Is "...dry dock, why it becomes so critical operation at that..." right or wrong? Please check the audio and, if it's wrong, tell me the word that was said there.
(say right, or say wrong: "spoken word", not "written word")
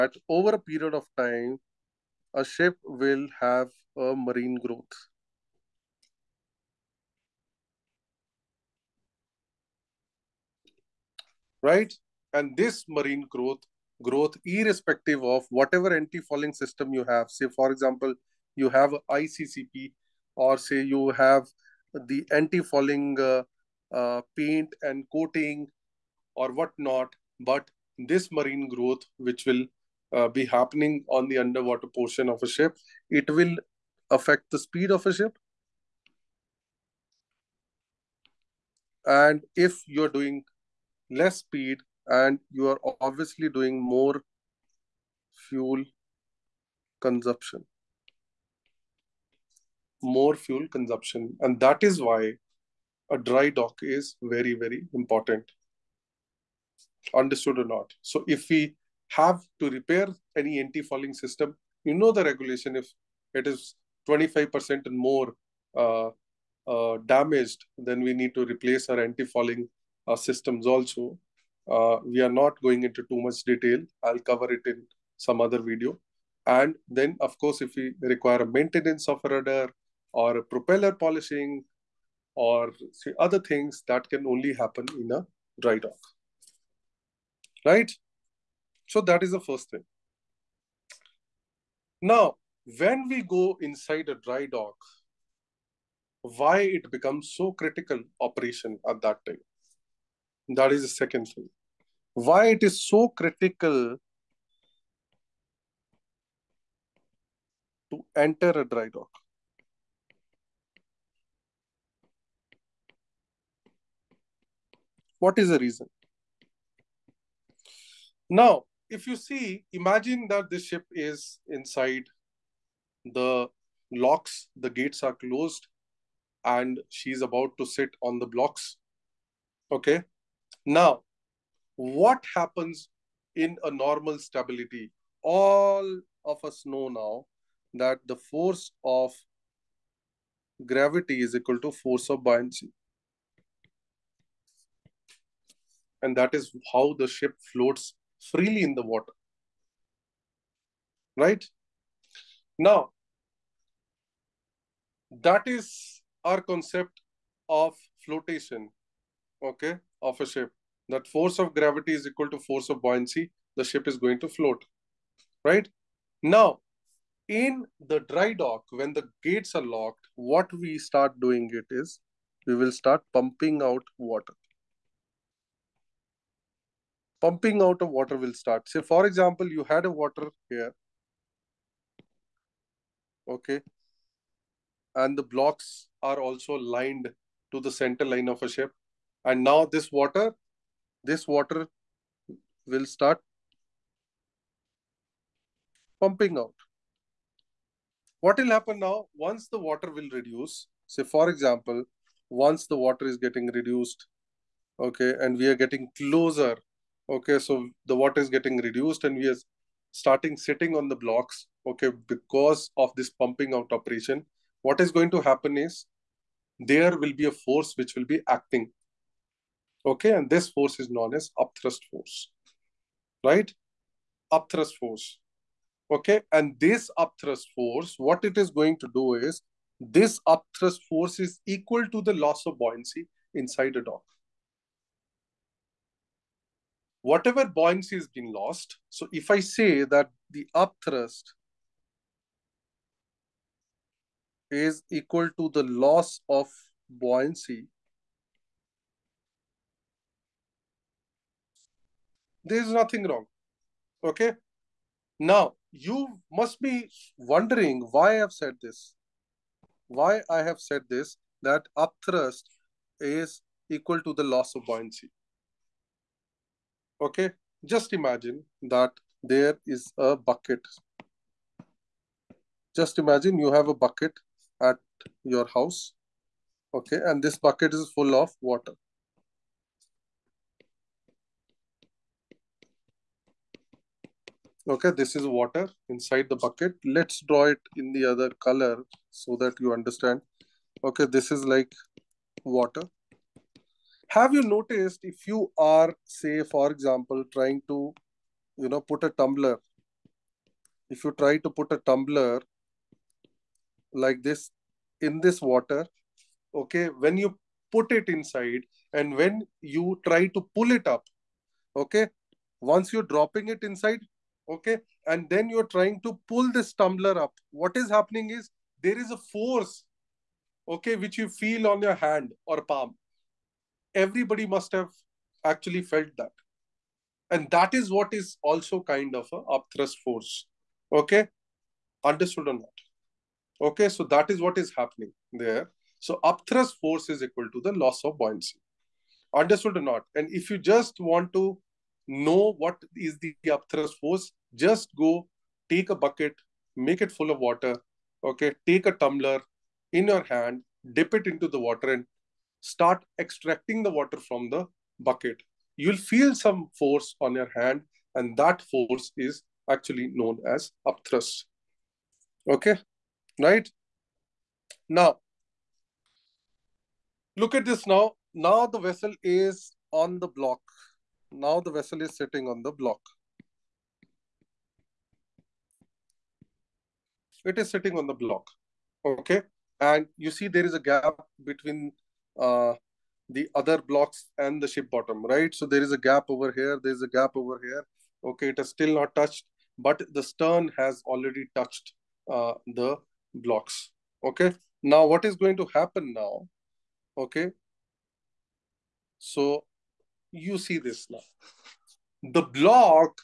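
right.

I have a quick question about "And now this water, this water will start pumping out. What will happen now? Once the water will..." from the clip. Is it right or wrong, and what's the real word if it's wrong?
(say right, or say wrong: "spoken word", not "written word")
right.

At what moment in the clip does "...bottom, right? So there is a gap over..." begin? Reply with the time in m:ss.
6:24.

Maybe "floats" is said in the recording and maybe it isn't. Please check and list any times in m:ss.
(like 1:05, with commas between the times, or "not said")
2:27, 2:44.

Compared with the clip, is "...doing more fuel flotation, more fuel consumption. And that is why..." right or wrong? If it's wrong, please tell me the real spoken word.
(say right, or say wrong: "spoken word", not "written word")
wrong: "consumption", not "flotation".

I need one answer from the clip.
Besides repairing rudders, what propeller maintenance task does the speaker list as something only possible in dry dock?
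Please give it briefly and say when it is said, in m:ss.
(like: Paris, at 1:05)
Propeller polishing, at 1:20.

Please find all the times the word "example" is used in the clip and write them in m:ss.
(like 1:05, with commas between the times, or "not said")
0:17, 2:59, 3:21, 4:56.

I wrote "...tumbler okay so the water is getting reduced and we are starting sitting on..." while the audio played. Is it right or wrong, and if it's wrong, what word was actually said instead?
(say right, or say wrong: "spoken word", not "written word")
wrong: "closer", not "tumbler".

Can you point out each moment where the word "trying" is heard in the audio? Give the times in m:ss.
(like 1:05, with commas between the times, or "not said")
4:57, 5:15.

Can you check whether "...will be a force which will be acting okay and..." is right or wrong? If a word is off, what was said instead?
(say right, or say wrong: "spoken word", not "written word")
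right.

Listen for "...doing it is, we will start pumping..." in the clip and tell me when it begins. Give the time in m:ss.
2:51.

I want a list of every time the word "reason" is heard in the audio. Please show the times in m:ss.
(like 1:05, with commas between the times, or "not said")
1:55.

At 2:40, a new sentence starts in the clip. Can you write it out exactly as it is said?
That force of gravity is equal to force of buoyancy.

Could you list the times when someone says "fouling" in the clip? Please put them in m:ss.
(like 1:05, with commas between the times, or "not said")
0:15, 0:22, 1:00, 1:08.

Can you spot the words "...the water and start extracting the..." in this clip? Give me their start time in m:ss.
5:51.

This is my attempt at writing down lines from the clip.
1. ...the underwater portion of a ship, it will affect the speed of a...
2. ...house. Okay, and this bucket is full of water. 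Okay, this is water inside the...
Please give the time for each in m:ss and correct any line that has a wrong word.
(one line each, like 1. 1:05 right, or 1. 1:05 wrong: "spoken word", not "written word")
1. 0:31 right
2. 4:35 right.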